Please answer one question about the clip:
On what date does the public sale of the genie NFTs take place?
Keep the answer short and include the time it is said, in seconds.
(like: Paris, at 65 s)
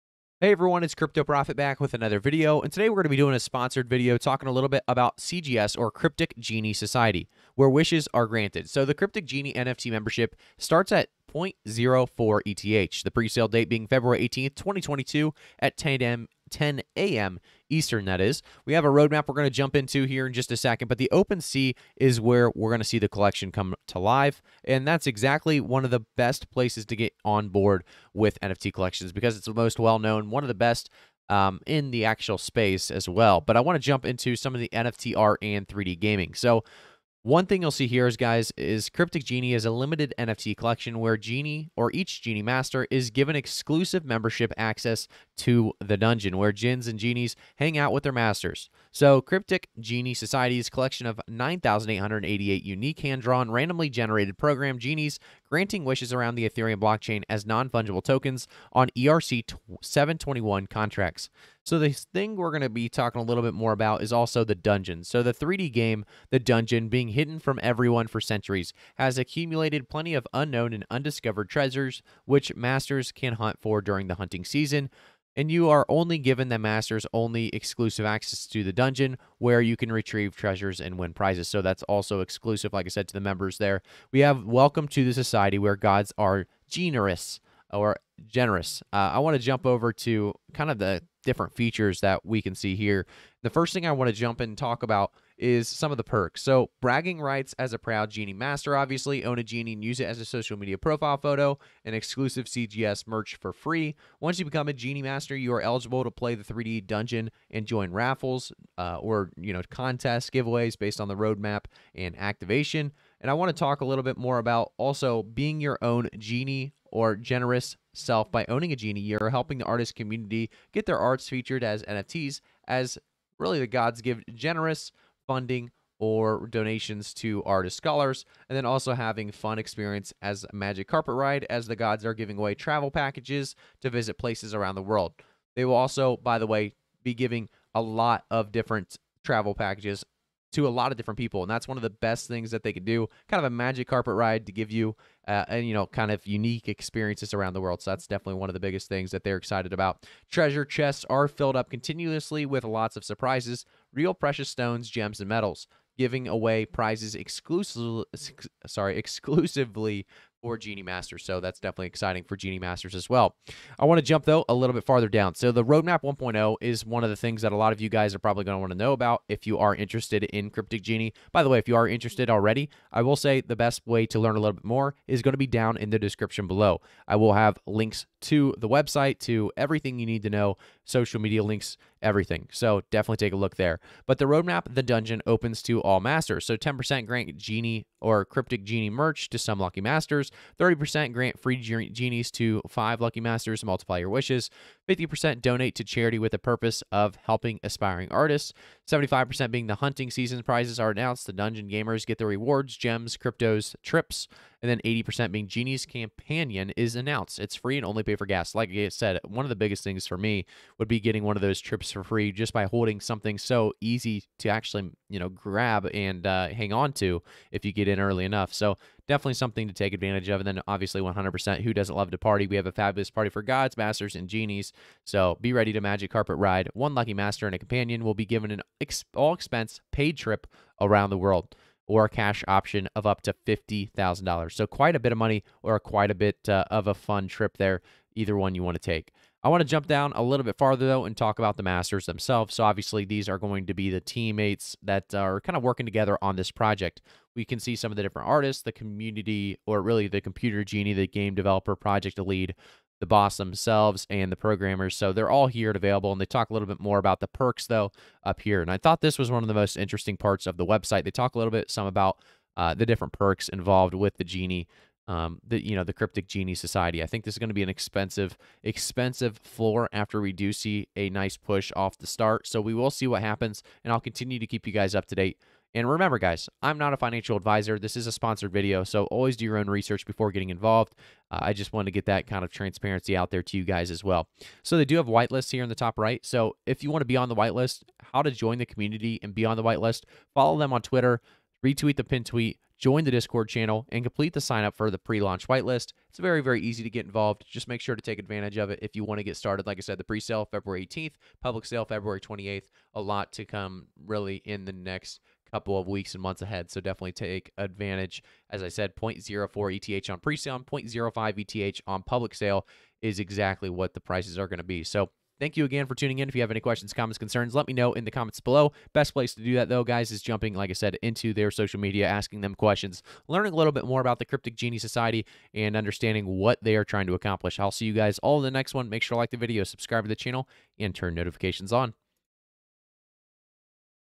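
February 28th, at 301 s.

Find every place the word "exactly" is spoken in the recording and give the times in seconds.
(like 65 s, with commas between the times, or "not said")
25 s, 313 s.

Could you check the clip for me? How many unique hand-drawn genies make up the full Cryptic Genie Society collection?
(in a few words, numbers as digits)
9,888.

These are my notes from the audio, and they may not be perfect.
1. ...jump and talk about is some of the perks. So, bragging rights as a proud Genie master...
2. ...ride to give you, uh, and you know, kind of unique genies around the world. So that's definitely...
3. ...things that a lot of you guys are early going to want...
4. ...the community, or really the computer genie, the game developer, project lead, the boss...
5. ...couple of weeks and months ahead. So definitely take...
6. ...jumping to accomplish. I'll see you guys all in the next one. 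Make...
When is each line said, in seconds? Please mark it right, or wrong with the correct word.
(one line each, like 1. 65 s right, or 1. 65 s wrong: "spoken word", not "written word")
1. 94 s right
2. 144 s wrong: "experiences", not "genies"
3. 167 s wrong: "probably", not "early"
4. 248 s right
5. 305 s right
6. 326 s wrong: "trying", not "jumping".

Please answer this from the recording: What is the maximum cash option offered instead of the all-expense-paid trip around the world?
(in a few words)
$50,000.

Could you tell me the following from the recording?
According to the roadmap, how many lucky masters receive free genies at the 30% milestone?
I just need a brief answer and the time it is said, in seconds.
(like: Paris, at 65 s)
5, at 192 s.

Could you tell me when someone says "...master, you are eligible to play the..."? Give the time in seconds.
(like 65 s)
105 s.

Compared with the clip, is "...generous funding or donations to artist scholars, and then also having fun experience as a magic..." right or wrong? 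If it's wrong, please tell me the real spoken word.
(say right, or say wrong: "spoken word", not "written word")
right.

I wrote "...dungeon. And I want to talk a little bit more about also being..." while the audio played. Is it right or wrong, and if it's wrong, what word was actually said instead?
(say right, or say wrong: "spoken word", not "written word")
wrong: "activation", not "dungeon".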